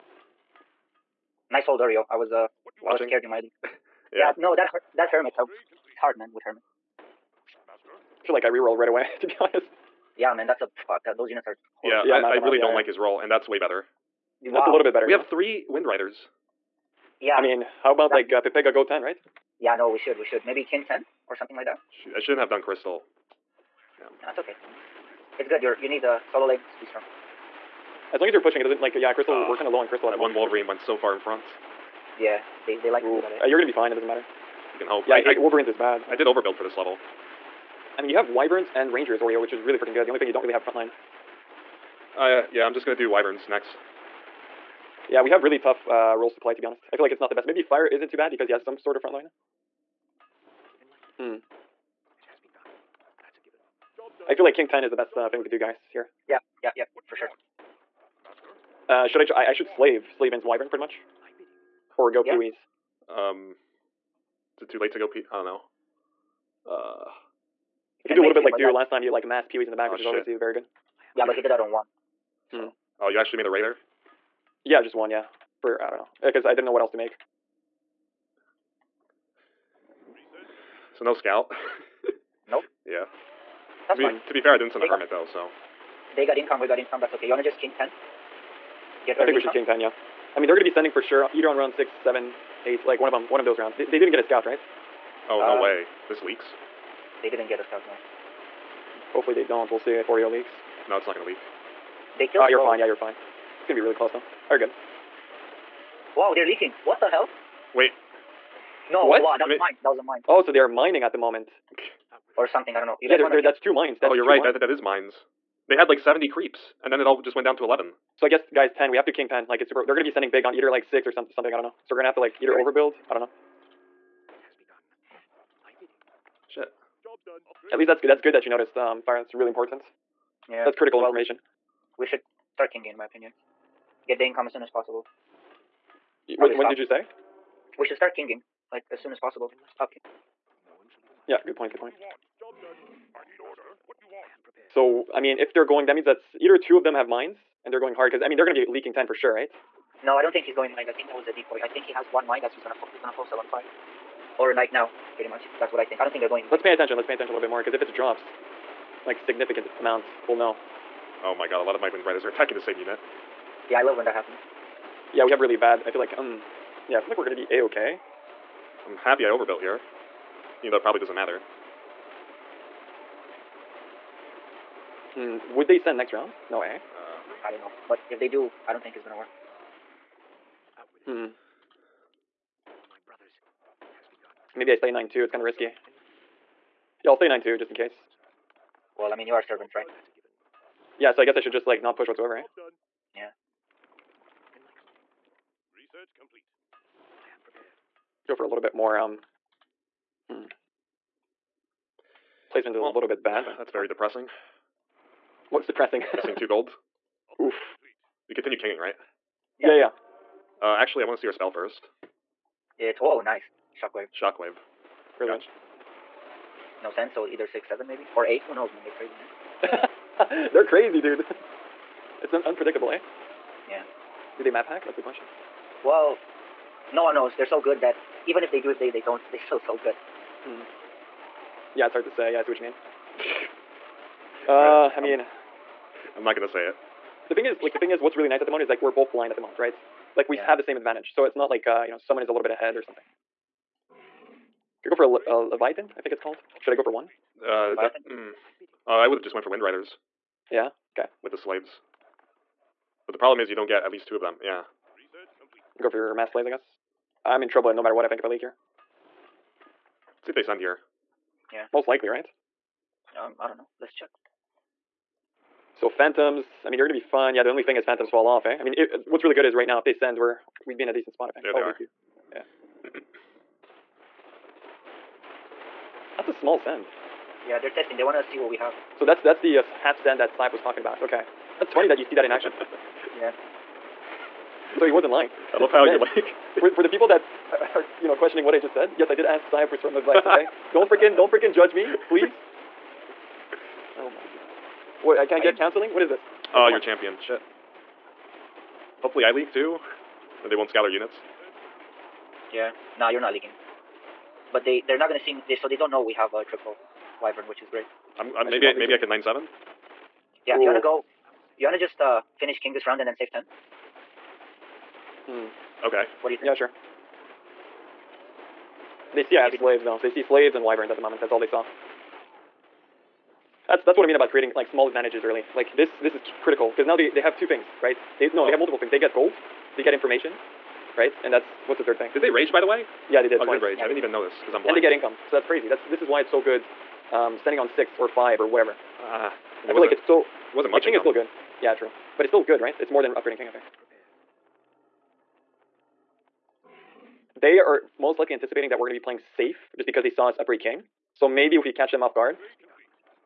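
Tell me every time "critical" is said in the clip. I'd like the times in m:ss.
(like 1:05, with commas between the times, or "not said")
2:10, 5:26.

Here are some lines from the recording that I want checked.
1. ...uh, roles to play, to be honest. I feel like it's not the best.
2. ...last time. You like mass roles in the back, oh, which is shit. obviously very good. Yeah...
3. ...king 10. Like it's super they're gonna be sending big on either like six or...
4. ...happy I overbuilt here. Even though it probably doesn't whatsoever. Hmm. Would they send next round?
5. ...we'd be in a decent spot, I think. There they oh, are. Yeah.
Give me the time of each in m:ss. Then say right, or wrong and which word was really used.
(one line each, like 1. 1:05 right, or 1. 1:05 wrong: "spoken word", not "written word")
1. 0:45 right
2. 1:08 wrong: "peewees", not "roles"
3. 1:59 right
4. 2:48 wrong: "matter", not "whatsoever"
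5. 4:30 right.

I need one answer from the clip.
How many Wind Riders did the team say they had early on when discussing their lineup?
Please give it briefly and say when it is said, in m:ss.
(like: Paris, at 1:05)
3, at 0:15.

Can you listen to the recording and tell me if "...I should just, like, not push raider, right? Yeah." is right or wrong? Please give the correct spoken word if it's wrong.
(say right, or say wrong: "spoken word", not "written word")
wrong: "whatsoever", not "raider".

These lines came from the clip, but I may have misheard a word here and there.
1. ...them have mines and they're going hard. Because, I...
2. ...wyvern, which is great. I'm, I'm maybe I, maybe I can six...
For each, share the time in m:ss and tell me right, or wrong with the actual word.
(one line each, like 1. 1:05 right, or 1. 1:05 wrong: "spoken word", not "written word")
1. 2:26 right
2. 5:07 wrong: "nine", not "six".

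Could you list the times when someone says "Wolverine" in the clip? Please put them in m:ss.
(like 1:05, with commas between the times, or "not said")
0:30, 0:35.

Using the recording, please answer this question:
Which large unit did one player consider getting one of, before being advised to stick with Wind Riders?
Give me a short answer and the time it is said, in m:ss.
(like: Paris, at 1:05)
Leviathan, at 4:05.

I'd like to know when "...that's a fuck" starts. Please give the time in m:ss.
0:10.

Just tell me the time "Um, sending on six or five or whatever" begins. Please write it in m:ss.
5:37.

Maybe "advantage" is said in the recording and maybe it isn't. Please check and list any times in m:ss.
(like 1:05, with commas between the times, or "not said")
4:00, 5:24.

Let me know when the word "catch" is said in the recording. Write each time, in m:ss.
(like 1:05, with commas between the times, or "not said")
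5:51.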